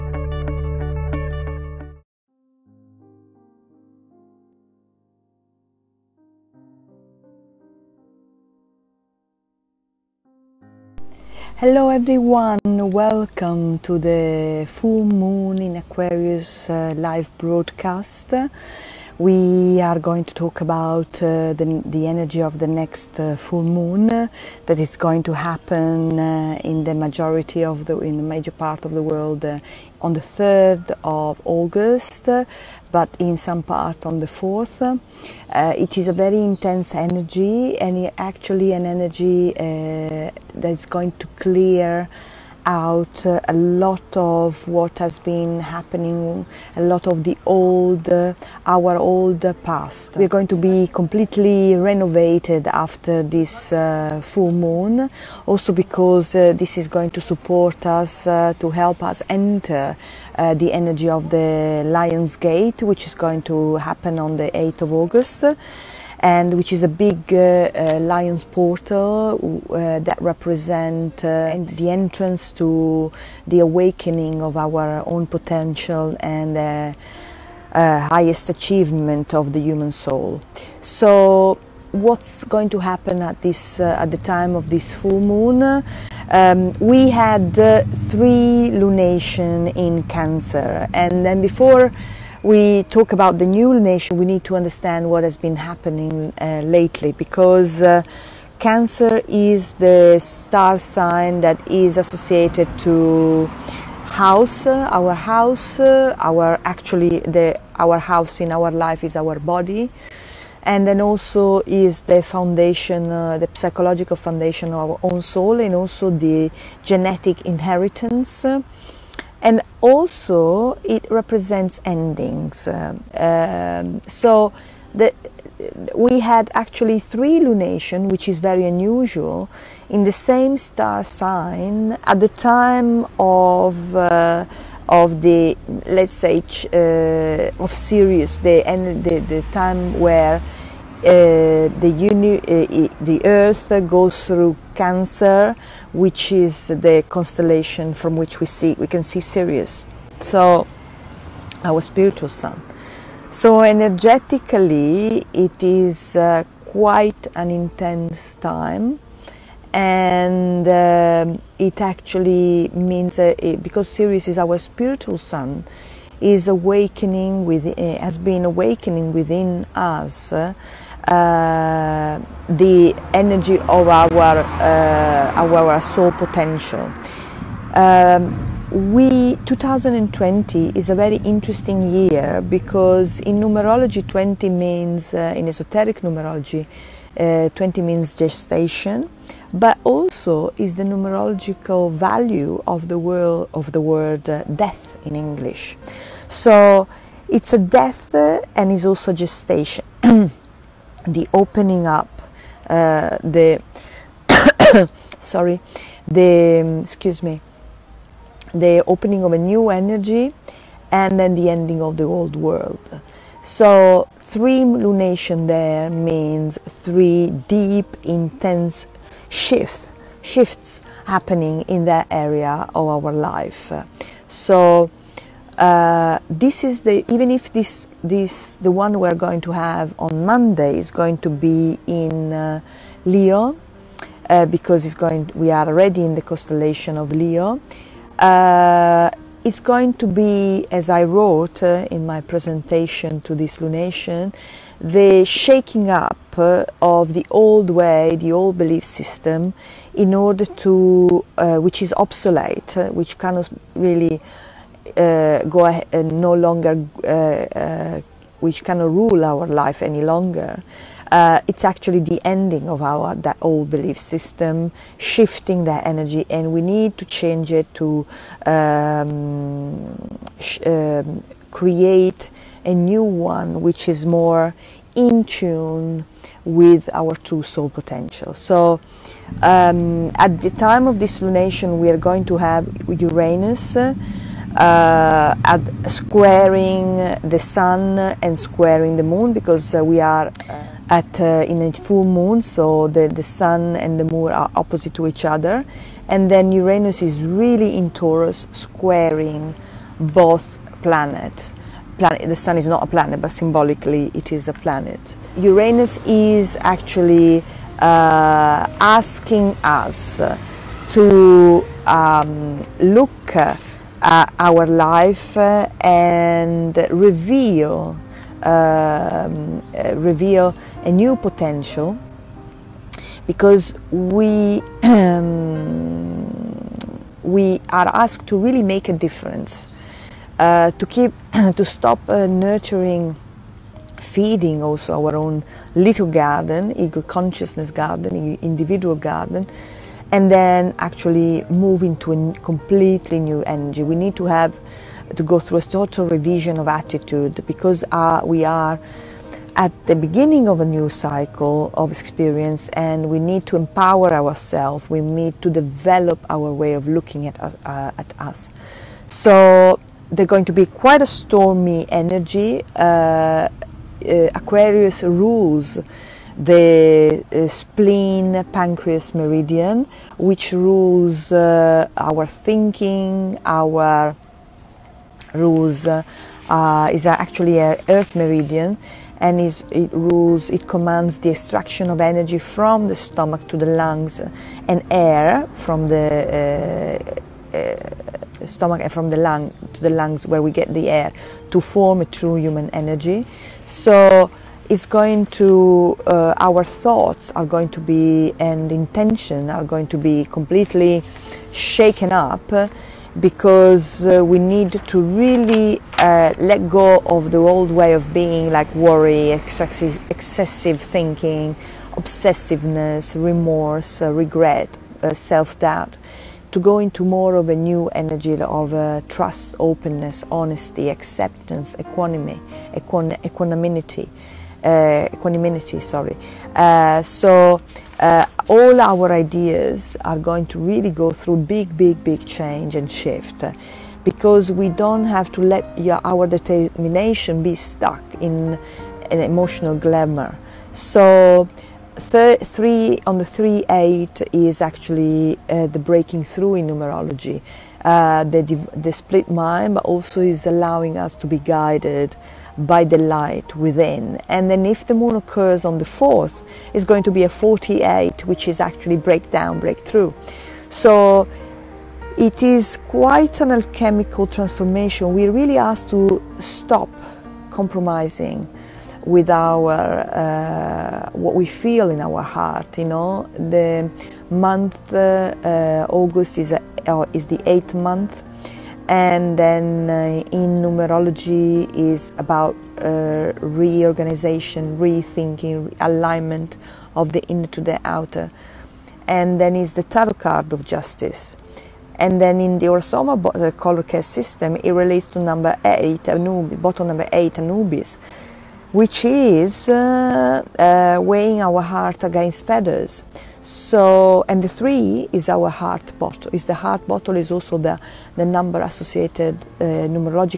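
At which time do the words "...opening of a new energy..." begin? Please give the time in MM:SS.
03:28.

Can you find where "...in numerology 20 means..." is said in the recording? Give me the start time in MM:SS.
03:03.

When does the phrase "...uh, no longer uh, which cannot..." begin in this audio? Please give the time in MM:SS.
04:15.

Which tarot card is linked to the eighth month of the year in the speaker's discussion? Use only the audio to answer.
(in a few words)
Justice.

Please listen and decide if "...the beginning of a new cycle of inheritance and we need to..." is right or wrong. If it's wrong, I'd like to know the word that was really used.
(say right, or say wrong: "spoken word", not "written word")
wrong: "experience", not "inheritance".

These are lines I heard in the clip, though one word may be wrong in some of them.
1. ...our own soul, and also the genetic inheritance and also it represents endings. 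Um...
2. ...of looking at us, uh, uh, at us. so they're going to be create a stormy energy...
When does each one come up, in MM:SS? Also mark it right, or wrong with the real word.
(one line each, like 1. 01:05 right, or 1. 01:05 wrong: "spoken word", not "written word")
1. 01:54 right
2. 05:56 wrong: "quite", not "create".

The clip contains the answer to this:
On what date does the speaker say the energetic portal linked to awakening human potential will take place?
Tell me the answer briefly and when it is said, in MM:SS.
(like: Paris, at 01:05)
8 August, at 01:04.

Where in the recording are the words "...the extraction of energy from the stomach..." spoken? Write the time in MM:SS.
06:21.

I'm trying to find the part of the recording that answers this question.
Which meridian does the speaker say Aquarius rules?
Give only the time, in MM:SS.
06:07.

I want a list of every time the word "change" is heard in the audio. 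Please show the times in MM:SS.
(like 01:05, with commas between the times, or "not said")
04:27, 07:12.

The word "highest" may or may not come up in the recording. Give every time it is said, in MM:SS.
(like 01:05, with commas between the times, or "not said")
01:17.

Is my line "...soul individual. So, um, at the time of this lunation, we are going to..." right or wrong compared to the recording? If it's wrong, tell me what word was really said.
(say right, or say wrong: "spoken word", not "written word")
wrong: "potential", not "individual".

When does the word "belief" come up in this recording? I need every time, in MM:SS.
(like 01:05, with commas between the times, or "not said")
04:08, 04:23.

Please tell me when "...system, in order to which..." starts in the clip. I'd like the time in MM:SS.
04:08.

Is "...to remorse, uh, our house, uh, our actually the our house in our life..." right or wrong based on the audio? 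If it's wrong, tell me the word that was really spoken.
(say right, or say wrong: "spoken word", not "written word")
wrong: "house", not "remorse".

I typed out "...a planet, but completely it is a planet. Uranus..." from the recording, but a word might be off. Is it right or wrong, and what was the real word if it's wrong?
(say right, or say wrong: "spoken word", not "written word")
wrong: "symbolically", not "completely".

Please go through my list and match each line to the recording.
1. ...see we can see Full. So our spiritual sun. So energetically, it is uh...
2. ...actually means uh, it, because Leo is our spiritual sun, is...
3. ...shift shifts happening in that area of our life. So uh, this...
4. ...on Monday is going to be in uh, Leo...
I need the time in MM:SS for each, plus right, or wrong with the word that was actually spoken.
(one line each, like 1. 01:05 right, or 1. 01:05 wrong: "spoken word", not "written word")
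1. 02:28 wrong: "Sirius", not "Full"
2. 02:41 wrong: "Sirius", not "Leo"
3. 03:39 right
4. 03:49 right.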